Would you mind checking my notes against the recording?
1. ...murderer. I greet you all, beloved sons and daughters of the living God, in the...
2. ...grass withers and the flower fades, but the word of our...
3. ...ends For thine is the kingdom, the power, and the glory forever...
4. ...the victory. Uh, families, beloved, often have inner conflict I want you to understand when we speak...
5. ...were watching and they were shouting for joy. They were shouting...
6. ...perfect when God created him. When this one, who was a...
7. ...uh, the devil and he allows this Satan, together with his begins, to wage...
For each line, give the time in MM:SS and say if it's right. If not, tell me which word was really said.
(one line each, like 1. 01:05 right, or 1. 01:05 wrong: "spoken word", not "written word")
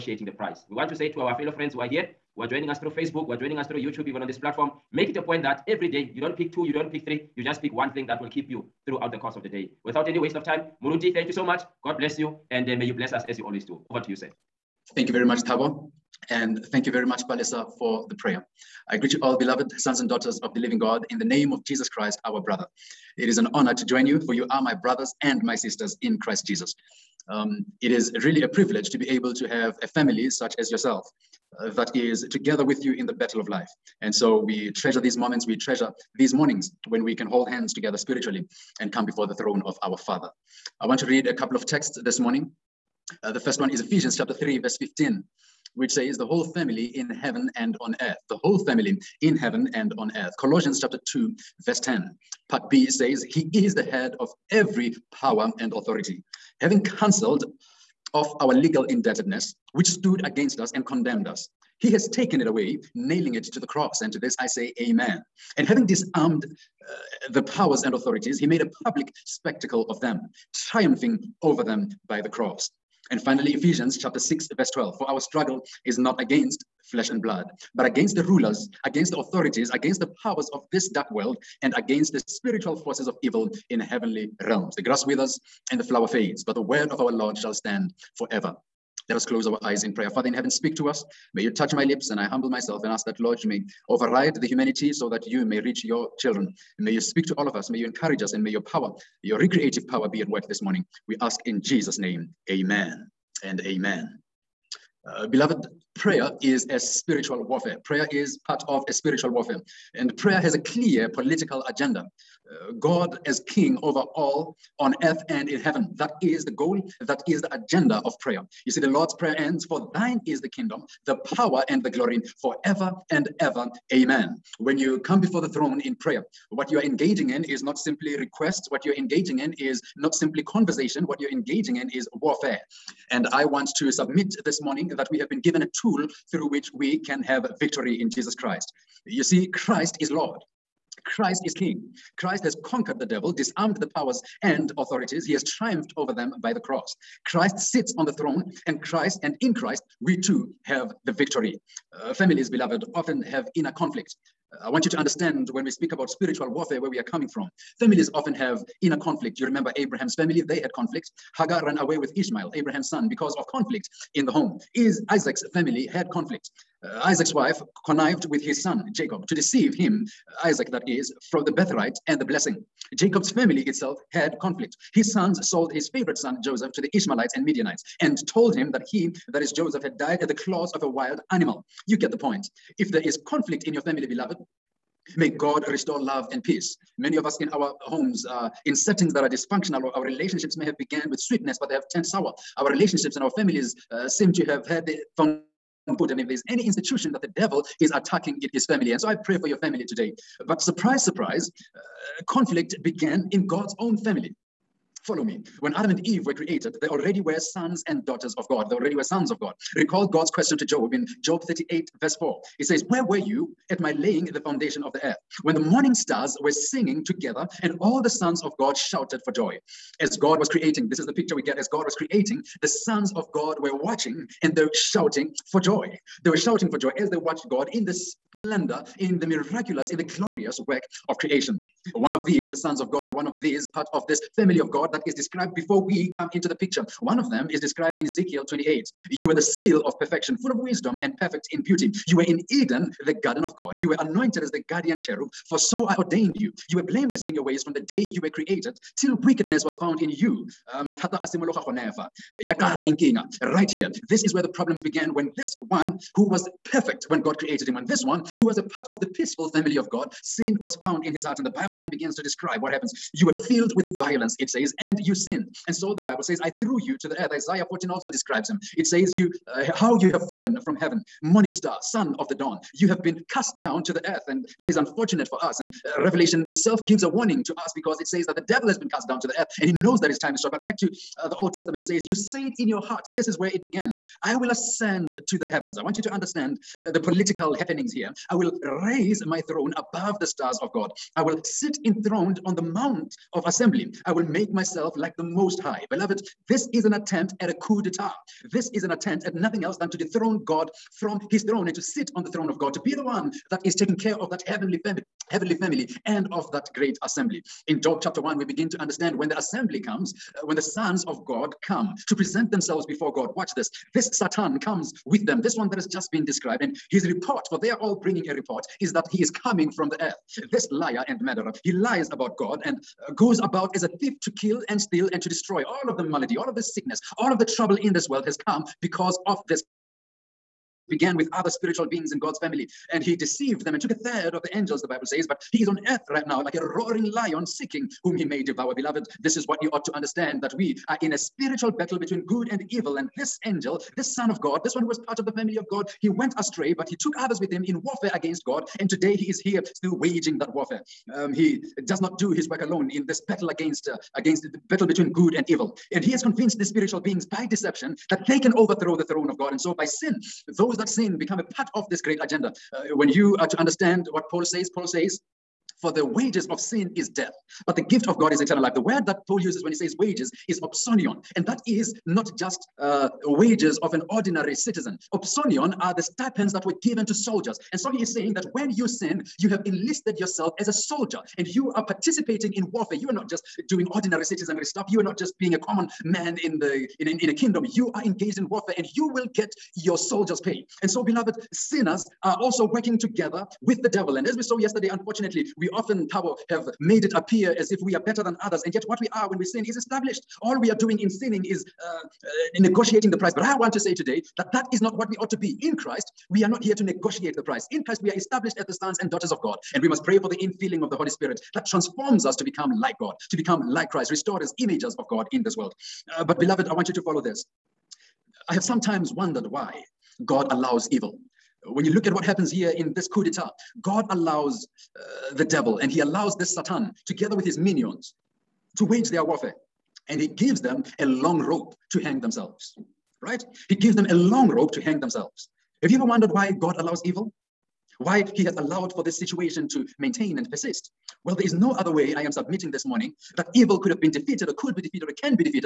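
1. 00:18 wrong: "prayer", not "murderer"
2. 01:24 right
3. 01:59 right
4. 02:31 right
5. 03:43 right
6. 04:16 right
7. 07:04 wrong: "minions", not "begins".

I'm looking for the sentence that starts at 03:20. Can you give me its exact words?
But surprise, surprise, uh, conflict began in God's own family.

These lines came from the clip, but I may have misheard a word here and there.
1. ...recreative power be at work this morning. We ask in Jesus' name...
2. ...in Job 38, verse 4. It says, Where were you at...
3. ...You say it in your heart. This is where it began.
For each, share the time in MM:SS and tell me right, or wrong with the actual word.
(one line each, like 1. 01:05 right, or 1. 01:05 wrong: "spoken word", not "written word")
1. 01:39 right
2. 03:30 right
3. 04:42 right.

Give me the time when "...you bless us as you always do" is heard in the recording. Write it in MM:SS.
00:12.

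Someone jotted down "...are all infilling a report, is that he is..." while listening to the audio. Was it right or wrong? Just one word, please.
wrong.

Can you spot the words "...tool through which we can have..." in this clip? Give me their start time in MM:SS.
02:15.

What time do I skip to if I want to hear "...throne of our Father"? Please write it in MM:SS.
00:39.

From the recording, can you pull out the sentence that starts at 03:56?
One of them is described in Ezekiel 28.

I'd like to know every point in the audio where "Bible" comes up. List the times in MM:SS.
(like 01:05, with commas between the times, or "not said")
04:21, 04:26, 05:34.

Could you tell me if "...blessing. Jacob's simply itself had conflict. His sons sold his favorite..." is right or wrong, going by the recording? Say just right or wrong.
wrong.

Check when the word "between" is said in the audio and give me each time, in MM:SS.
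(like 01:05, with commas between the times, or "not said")
05:41, 05:54.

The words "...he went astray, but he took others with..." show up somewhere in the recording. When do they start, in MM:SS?
05:45.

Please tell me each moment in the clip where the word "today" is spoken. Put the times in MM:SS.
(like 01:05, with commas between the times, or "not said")
03:19, 05:48, 06:43.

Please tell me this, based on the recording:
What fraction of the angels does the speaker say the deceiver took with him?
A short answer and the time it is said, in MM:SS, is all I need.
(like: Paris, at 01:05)
A third, at 05:33.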